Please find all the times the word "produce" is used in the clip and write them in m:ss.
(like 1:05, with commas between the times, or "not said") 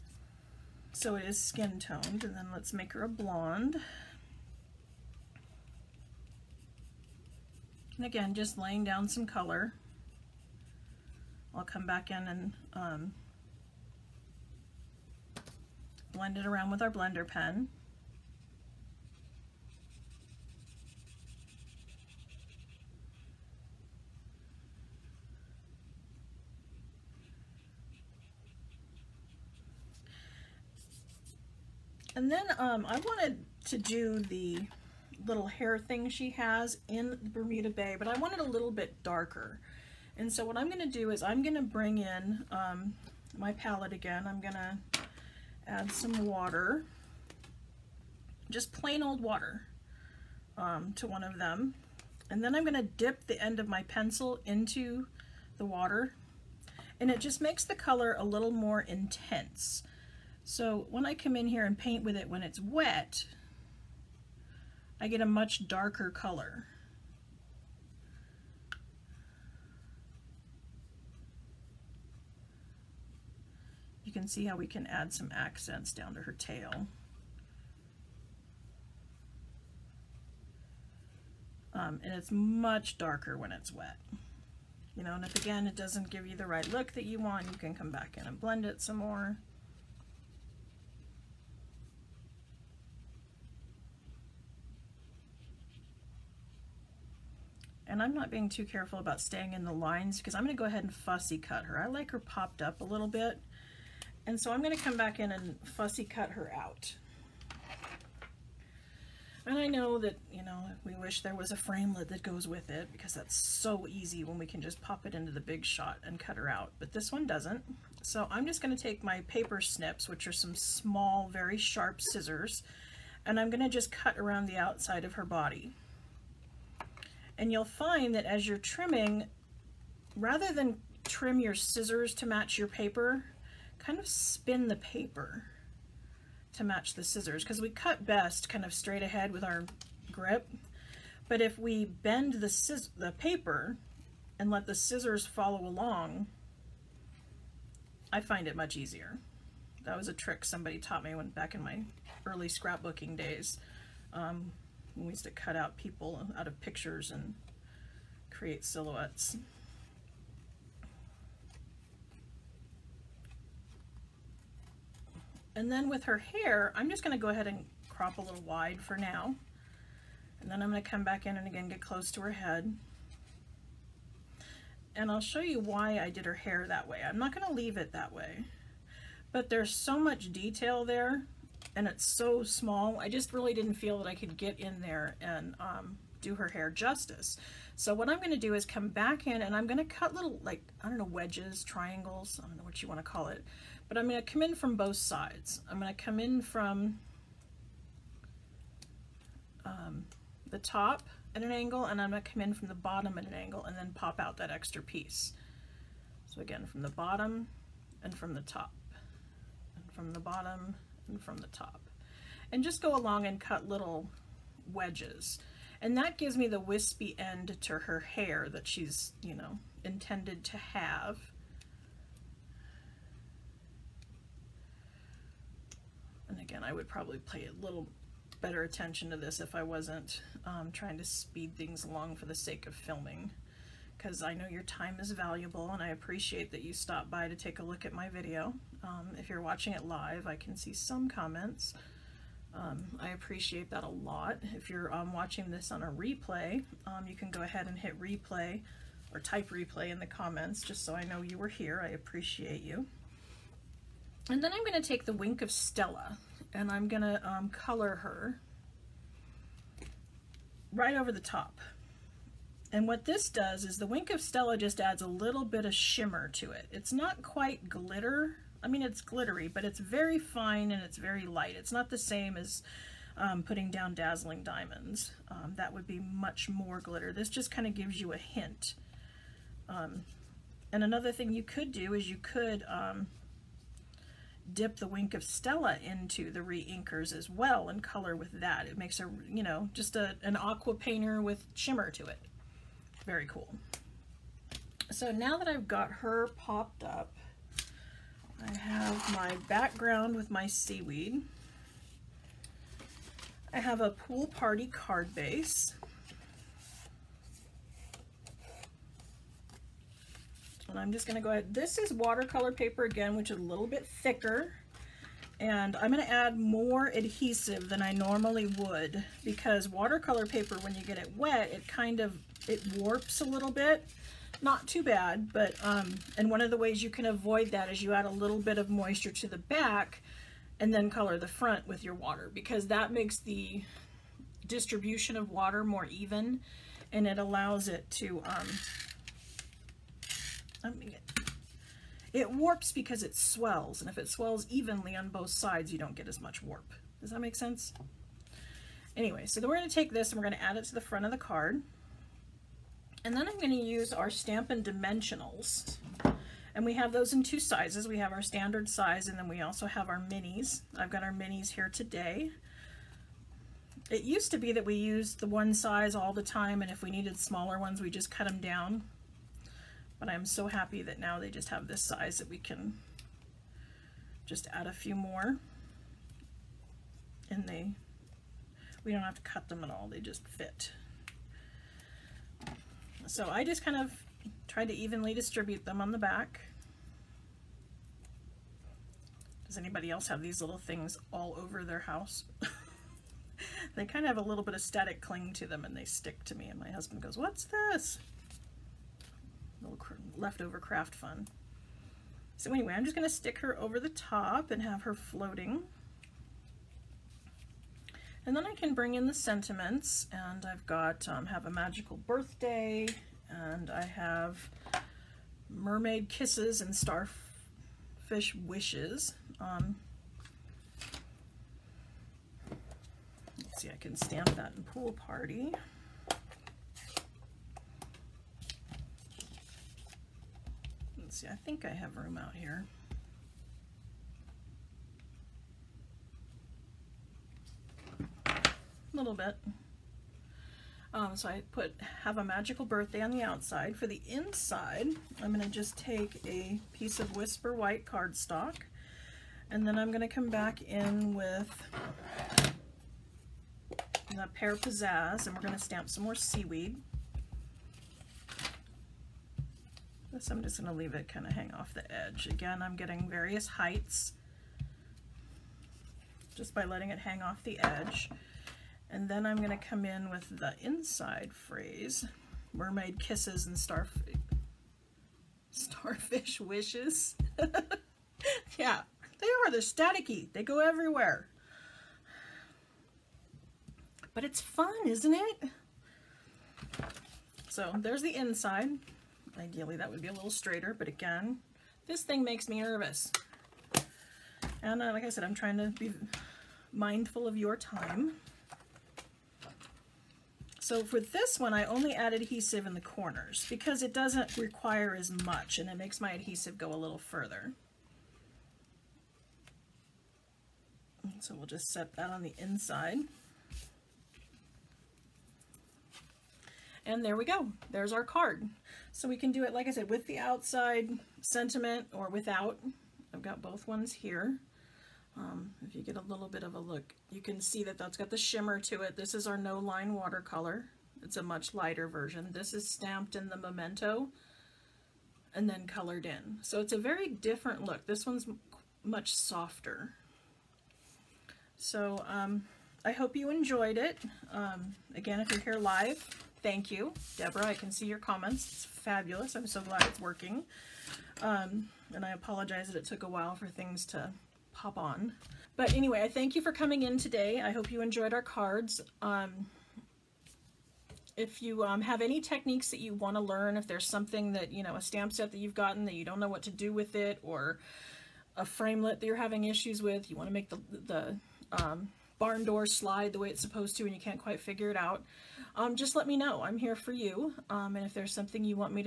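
not said.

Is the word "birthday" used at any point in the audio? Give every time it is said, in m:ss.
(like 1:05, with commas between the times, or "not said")
6:51, 7:22.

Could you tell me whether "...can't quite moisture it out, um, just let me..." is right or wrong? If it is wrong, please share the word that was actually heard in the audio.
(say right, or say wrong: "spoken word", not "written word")
wrong: "figure", not "moisture".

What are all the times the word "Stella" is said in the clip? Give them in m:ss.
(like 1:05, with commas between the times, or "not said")
4:15, 4:24, 4:45.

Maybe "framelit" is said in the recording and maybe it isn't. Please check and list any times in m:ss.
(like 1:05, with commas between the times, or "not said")
1:51, 9:28.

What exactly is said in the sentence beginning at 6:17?
And they, we don't have to cut them at all, they just fit.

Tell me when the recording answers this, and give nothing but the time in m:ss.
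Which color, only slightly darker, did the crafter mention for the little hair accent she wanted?
0:37.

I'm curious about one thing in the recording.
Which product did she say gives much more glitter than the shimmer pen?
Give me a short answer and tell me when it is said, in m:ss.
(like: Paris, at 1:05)
dazzling diamonds, at 4:33.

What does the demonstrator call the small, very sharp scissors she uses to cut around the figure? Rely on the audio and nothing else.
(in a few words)
paper snips.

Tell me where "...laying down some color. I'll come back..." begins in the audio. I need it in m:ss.
0:08.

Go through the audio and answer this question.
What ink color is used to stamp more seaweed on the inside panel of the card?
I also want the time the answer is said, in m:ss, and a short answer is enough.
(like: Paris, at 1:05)
Pear Pizzazz, at 7:34.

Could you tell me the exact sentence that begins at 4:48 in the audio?
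It makes a, you know, just a, an aqua painter with shimmer to it.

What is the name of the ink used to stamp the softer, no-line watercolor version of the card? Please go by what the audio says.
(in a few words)
Memento.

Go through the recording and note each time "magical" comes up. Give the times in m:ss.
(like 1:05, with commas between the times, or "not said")
6:51, 7:22.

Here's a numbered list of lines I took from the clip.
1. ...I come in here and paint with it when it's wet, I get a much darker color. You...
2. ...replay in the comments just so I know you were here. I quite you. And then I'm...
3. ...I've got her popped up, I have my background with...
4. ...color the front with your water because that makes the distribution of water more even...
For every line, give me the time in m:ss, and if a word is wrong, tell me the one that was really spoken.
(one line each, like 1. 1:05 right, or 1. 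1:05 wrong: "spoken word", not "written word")
1. 1:01 right
2. 4:09 wrong: "appreciate", not "quite"
3. 4:55 right
4. 5:30 right.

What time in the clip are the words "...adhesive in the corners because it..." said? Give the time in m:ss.
8:22.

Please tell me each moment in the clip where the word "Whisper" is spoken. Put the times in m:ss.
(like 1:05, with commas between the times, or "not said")
7:27.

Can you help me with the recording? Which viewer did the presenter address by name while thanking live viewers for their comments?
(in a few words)
Deborah.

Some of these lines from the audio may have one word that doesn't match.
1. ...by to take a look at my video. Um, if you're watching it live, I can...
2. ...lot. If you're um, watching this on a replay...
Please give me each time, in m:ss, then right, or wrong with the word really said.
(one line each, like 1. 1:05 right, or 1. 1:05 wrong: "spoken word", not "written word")
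1. 3:57 right
2. 4:03 right.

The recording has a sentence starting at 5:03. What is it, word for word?
I have a pool party card base.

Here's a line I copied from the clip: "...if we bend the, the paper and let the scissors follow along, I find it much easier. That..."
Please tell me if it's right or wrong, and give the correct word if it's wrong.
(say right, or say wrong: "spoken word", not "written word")
right.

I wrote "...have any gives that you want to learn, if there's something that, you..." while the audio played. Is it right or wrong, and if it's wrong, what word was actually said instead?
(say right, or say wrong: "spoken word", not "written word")
wrong: "techniques", not "gives".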